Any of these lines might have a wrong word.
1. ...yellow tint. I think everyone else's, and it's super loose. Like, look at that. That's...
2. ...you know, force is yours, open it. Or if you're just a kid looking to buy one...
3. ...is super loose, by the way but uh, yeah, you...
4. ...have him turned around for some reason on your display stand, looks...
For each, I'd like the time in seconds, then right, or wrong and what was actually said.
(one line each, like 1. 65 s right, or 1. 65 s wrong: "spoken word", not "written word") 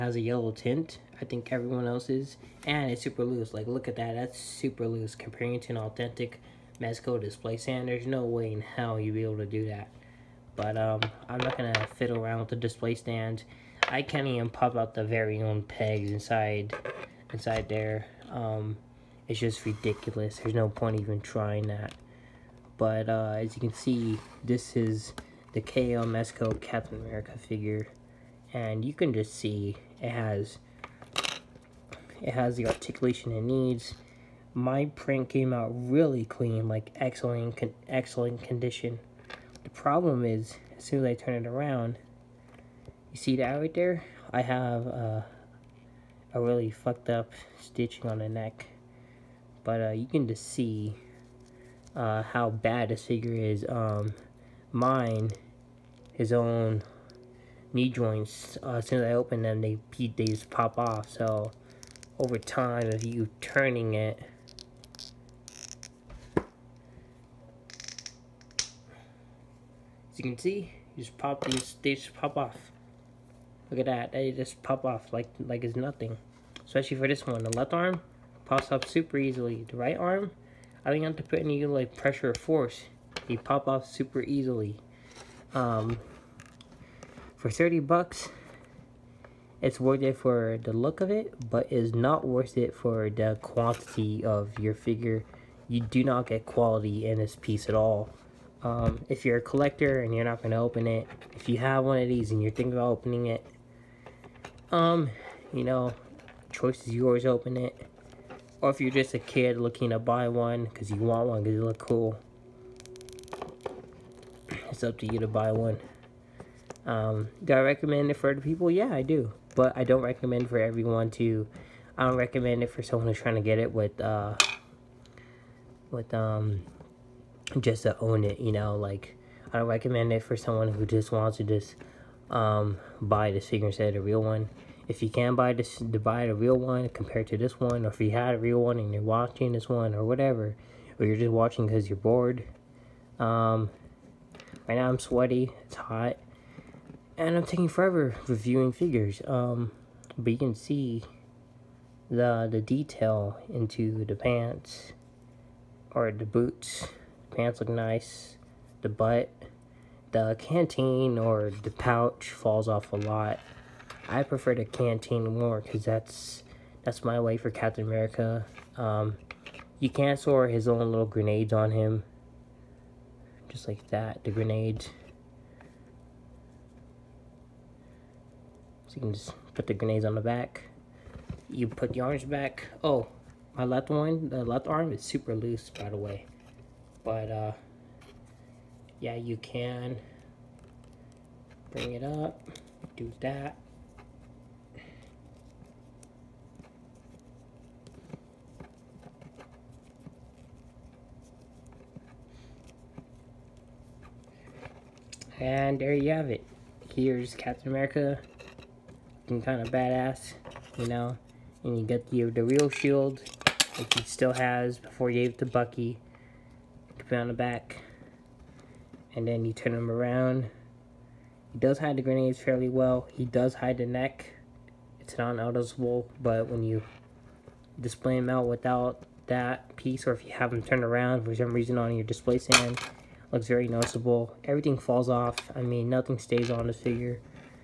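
1. 0 s right
2. 105 s wrong: "choice", not "force"
3. 184 s right
4. 230 s right.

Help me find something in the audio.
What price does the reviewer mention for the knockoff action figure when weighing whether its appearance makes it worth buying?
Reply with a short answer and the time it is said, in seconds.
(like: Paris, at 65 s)
$30, at 87 s.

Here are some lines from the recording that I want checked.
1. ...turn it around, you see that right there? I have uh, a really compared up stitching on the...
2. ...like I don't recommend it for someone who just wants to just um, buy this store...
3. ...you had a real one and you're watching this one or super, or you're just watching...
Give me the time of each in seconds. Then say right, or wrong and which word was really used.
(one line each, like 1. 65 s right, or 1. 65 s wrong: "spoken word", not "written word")
1. 41 s wrong: "fucked", not "compared"
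2. 128 s wrong: "figure", not "store"
3. 138 s wrong: "whatever", not "super".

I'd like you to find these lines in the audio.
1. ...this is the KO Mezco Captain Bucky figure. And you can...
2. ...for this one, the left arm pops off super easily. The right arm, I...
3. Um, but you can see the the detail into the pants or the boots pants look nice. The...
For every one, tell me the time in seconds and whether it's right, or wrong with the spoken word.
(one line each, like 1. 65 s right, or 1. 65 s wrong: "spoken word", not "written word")
1. 24 s wrong: "America", not "Bucky"
2. 76 s right
3. 149 s right.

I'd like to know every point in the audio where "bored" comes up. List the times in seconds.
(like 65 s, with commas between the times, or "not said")
141 s.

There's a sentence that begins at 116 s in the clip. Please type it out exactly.
Um, do I recommend it for other people?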